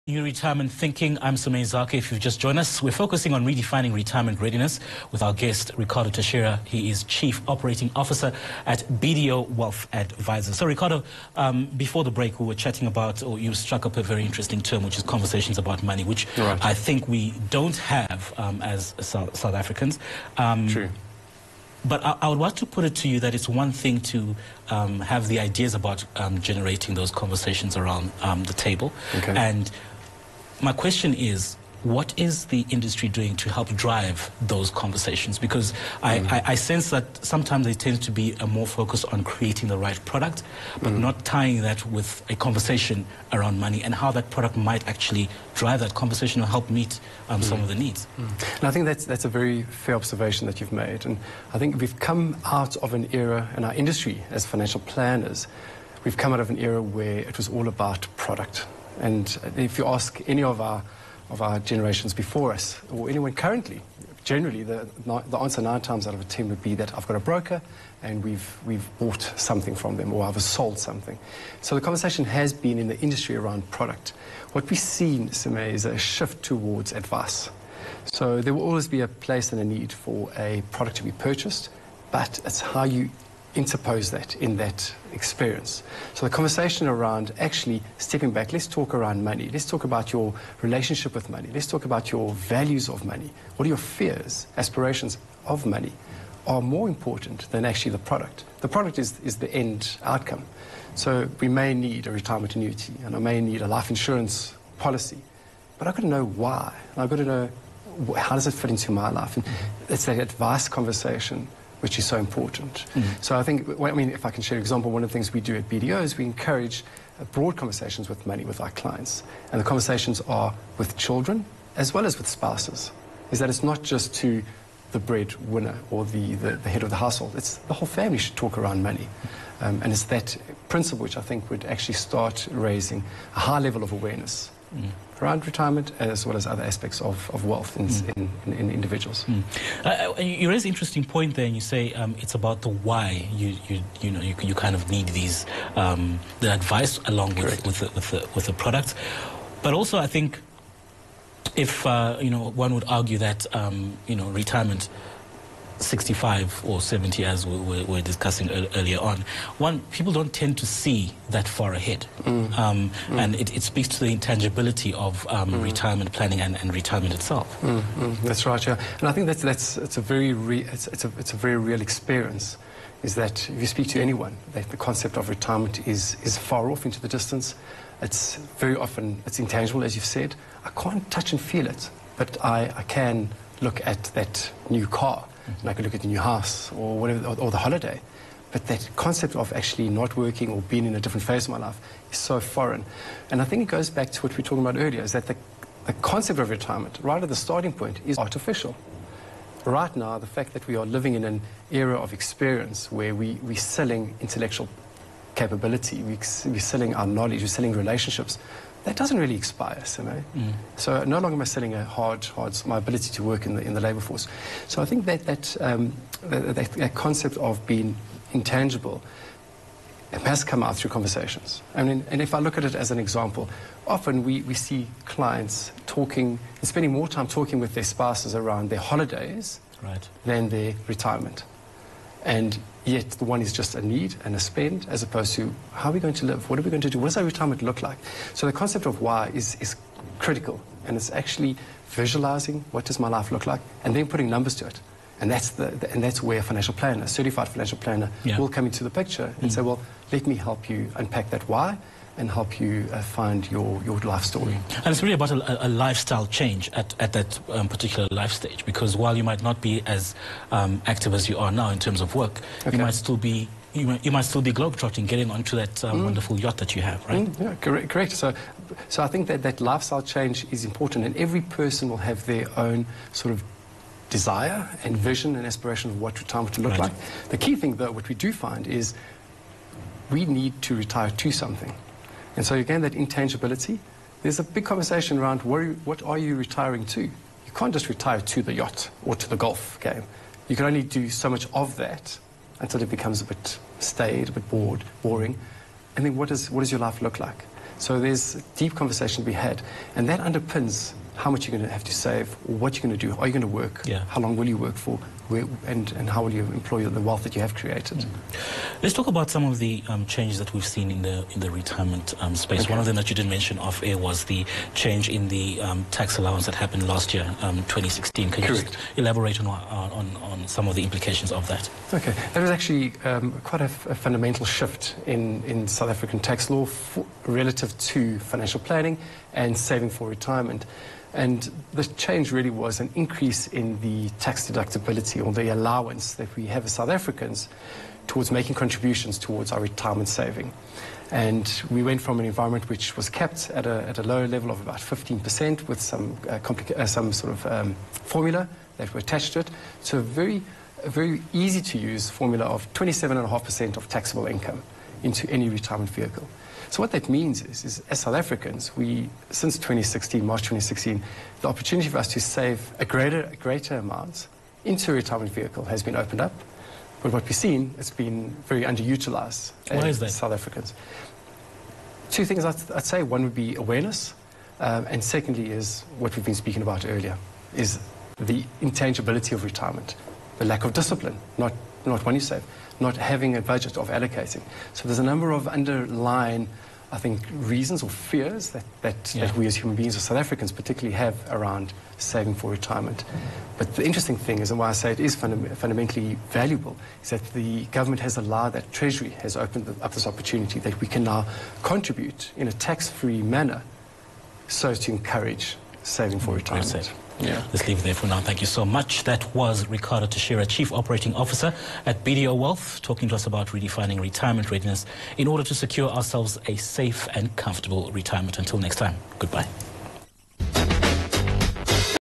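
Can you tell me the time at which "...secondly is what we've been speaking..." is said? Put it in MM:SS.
06:15.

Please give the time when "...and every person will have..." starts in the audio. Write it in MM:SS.
04:31.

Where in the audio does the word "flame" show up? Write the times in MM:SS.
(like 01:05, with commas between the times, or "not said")
not said.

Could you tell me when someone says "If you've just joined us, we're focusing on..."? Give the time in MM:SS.
00:01.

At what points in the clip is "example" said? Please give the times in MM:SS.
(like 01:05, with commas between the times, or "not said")
01:54, 03:42.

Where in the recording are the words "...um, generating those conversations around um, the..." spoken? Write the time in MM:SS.
00:26.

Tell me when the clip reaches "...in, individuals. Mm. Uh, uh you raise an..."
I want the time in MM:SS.
02:18.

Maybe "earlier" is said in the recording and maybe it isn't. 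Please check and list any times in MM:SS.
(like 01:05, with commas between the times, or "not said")
02:38, 03:14, 06:16.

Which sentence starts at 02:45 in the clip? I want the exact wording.
retirement planning and, and retirement itself.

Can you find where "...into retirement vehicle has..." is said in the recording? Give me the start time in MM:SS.
06:04.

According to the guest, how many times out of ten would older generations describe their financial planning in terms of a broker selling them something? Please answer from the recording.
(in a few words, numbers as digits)
9.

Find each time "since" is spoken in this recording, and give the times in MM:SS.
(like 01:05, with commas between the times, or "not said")
05:59.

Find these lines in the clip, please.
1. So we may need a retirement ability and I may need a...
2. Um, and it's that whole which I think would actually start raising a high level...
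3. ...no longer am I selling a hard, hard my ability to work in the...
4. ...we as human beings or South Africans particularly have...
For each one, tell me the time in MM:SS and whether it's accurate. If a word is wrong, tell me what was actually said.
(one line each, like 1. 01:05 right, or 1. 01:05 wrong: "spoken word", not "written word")
1. 01:40 wrong: "annuity", not "ability"
2. 02:09 wrong: "principle", not "whole"
3. 03:31 right
4. 06:29 right.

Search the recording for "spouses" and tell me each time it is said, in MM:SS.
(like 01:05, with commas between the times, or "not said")
02:02, 03:47.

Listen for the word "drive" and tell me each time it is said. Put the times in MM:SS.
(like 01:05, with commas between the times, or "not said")
00:33, 00:45.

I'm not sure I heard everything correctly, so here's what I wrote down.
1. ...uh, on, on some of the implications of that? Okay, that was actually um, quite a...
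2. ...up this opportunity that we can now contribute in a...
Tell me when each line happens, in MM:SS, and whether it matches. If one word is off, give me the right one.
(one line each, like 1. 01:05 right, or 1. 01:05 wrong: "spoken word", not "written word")
1. 05:19 right
2. 06:39 right.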